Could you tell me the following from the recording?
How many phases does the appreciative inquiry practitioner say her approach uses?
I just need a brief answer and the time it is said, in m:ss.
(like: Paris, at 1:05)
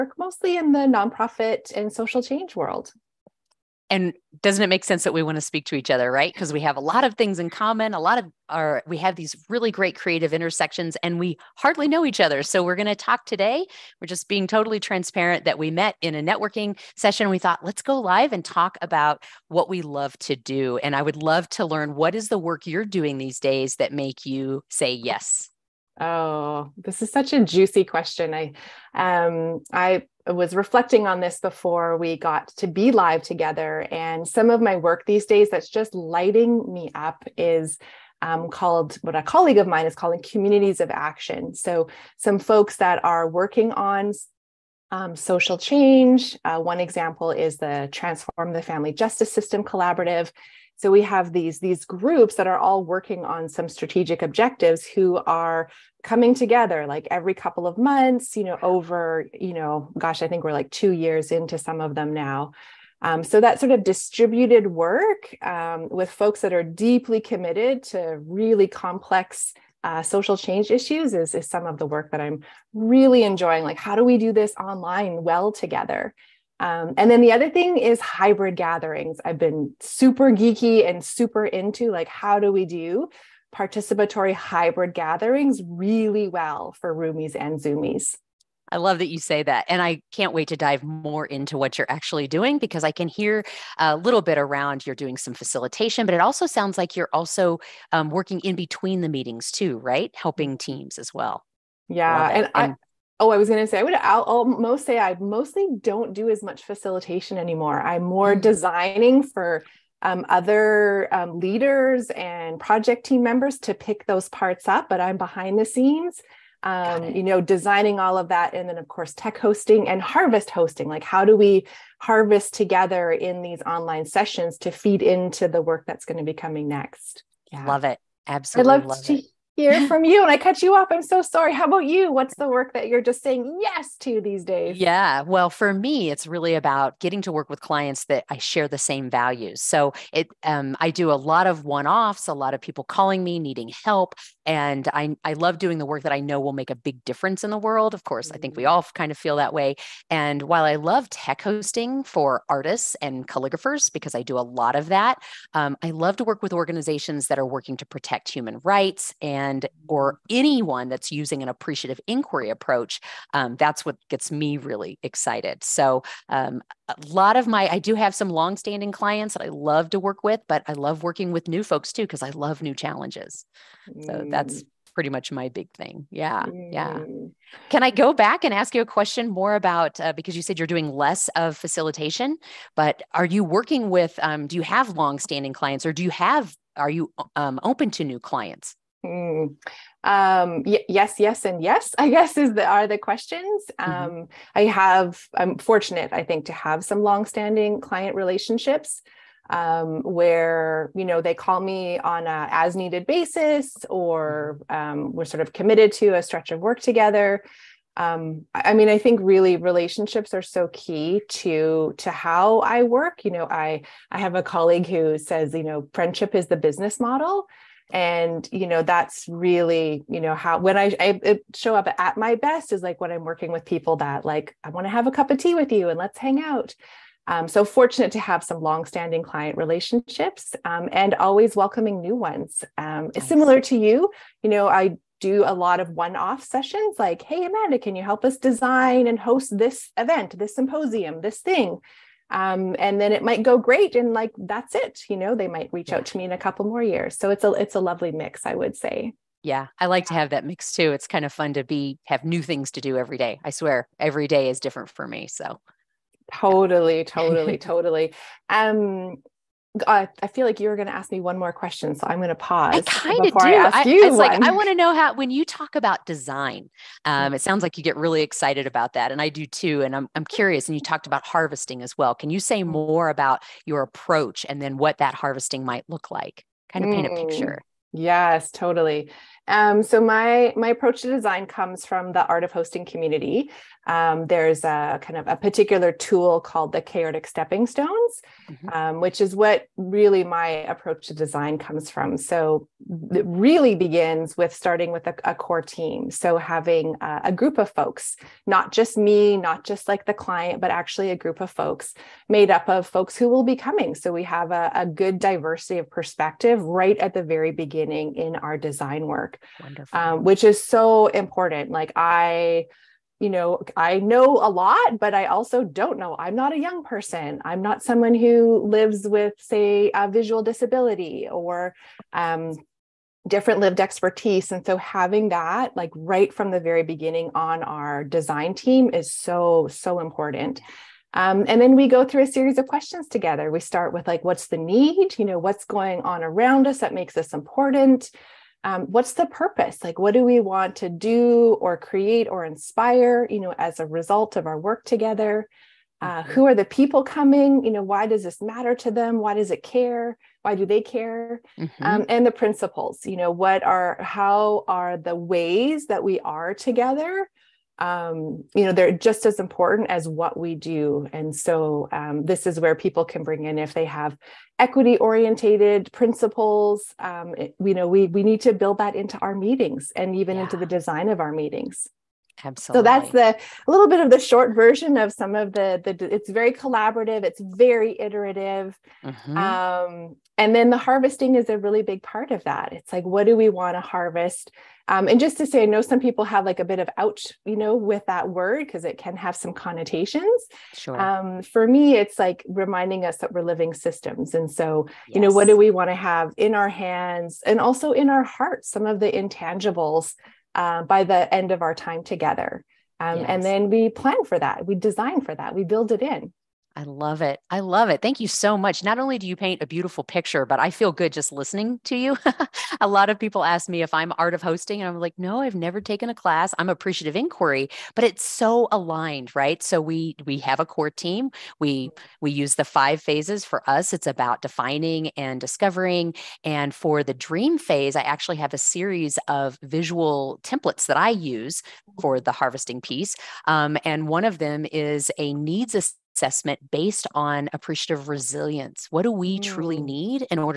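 5, at 7:02.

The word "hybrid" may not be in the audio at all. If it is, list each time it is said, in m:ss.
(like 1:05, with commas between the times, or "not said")
1:18, 1:24.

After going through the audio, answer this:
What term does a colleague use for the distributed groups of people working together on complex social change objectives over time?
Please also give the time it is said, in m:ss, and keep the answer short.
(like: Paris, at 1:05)
communities of action, at 0:40.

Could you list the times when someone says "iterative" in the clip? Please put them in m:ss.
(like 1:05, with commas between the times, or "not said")
6:17.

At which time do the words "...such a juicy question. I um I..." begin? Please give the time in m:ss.
0:27.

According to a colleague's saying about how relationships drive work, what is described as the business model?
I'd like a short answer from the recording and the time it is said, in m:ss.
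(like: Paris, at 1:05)
friendship, at 3:35.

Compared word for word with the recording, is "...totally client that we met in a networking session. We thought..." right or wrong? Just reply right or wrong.
wrong.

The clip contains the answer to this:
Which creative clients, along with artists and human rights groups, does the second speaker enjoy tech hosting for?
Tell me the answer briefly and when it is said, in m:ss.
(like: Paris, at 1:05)
calligraphers, at 2:33.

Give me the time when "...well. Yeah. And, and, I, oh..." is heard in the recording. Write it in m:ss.
1:41.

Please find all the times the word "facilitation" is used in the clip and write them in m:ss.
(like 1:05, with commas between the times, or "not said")
1:35, 1:46, 3:01.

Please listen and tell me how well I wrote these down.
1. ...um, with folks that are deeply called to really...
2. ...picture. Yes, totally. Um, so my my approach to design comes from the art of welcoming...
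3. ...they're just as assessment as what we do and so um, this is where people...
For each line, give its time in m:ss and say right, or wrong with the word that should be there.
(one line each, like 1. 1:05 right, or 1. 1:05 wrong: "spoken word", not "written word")
1. 1:05 wrong: "committed", not "called"
2. 4:37 wrong: "hosting", not "welcoming"
3. 5:58 wrong: "important", not "assessment".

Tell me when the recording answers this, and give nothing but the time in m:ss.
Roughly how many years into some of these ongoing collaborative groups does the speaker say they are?
1:00.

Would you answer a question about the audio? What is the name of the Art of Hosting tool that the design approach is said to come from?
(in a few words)
chaordic stepping stones.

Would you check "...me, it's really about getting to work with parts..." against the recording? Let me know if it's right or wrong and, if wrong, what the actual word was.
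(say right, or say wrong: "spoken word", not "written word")
wrong: "clients", not "parts".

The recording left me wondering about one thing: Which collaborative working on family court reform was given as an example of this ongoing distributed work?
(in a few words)
Transform the Family Justice System Collaborative.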